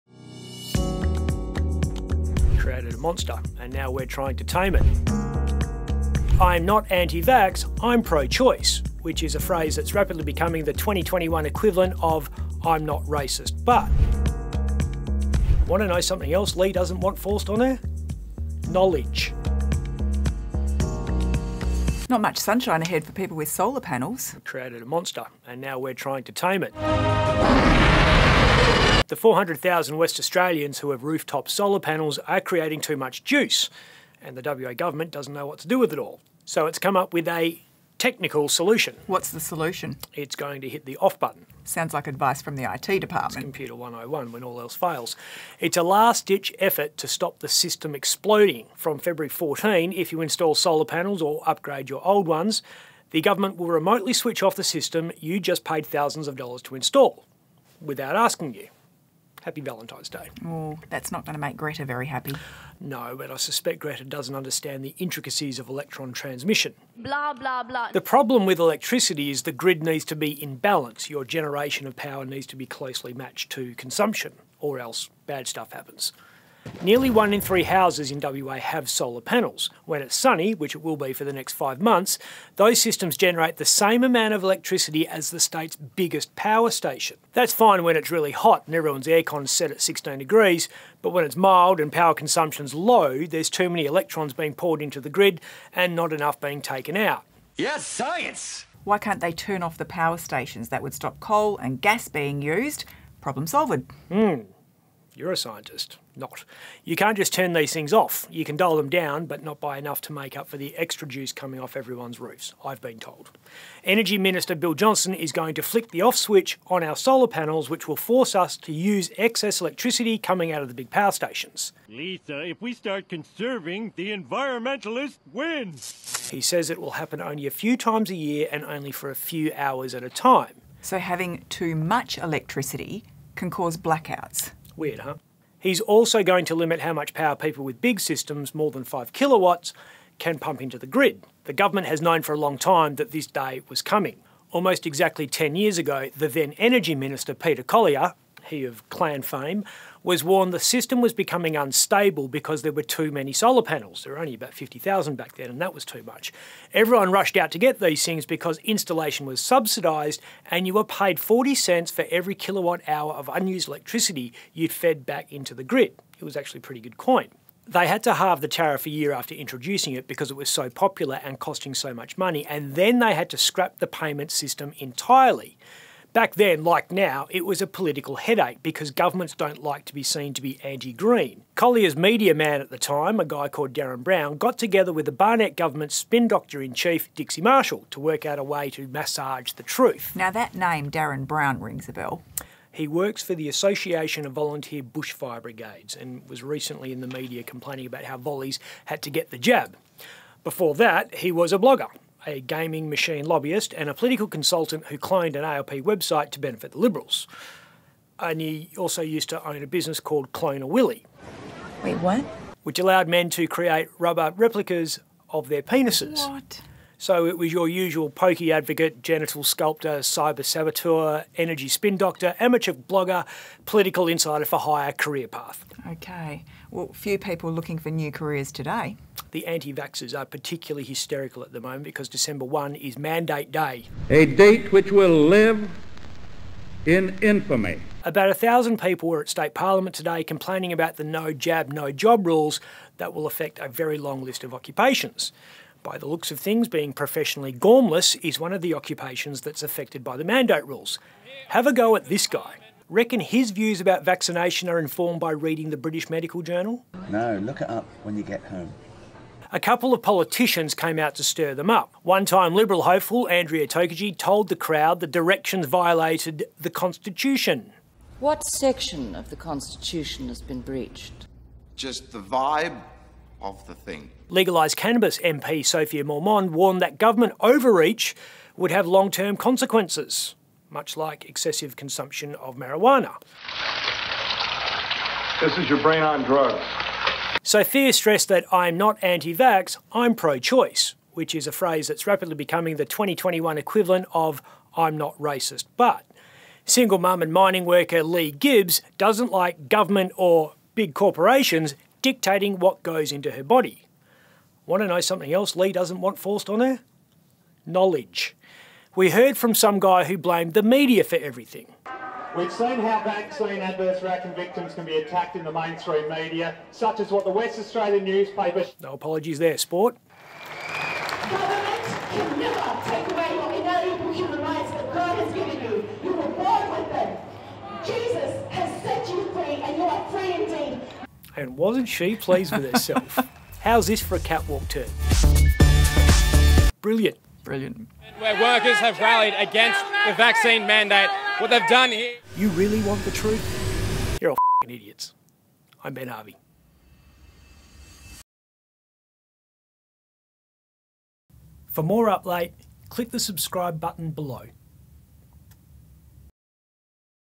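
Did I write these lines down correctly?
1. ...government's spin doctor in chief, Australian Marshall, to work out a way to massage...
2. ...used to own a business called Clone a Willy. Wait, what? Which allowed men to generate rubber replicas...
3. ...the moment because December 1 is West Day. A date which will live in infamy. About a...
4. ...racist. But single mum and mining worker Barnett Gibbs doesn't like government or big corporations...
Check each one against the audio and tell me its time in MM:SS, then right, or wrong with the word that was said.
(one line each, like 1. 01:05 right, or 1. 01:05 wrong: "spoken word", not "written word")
1. 03:05 wrong: "Dixie", not "Australian"
2. 03:29 wrong: "create", not "generate"
3. 03:51 wrong: "Mandate", not "West"
4. 04:55 wrong: "Lee", not "Barnett".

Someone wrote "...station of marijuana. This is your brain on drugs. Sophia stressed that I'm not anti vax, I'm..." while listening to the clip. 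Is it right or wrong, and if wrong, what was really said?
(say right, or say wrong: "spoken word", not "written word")
wrong: "consumption", not "station".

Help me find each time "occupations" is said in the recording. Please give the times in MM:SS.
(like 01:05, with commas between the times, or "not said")
04:04, 04:08.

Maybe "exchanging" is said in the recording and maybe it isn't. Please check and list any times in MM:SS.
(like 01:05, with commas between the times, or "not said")
not said.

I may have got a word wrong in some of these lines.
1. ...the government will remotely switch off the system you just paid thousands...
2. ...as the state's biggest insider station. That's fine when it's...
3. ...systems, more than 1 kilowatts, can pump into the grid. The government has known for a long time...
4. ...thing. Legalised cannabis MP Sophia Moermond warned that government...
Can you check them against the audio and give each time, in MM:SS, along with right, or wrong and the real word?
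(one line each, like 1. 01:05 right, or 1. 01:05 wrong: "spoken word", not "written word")
1. 00:53 right
2. 01:25 wrong: "power", not "insider"
3. 02:17 wrong: "5", not "1"
4. 04:33 right.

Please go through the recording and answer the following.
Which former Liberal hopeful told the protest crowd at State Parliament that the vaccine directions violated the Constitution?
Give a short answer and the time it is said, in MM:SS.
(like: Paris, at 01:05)
Andrea Tokaji, at 04:23.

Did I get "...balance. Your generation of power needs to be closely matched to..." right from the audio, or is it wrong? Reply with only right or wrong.
right.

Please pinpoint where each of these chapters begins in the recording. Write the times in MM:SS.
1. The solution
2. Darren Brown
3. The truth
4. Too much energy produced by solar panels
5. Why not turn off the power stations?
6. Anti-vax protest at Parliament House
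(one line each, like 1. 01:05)
1. 00:38
2. 03:09
3. 05:41
4. 00:22
5. 01:38
6. 03:49.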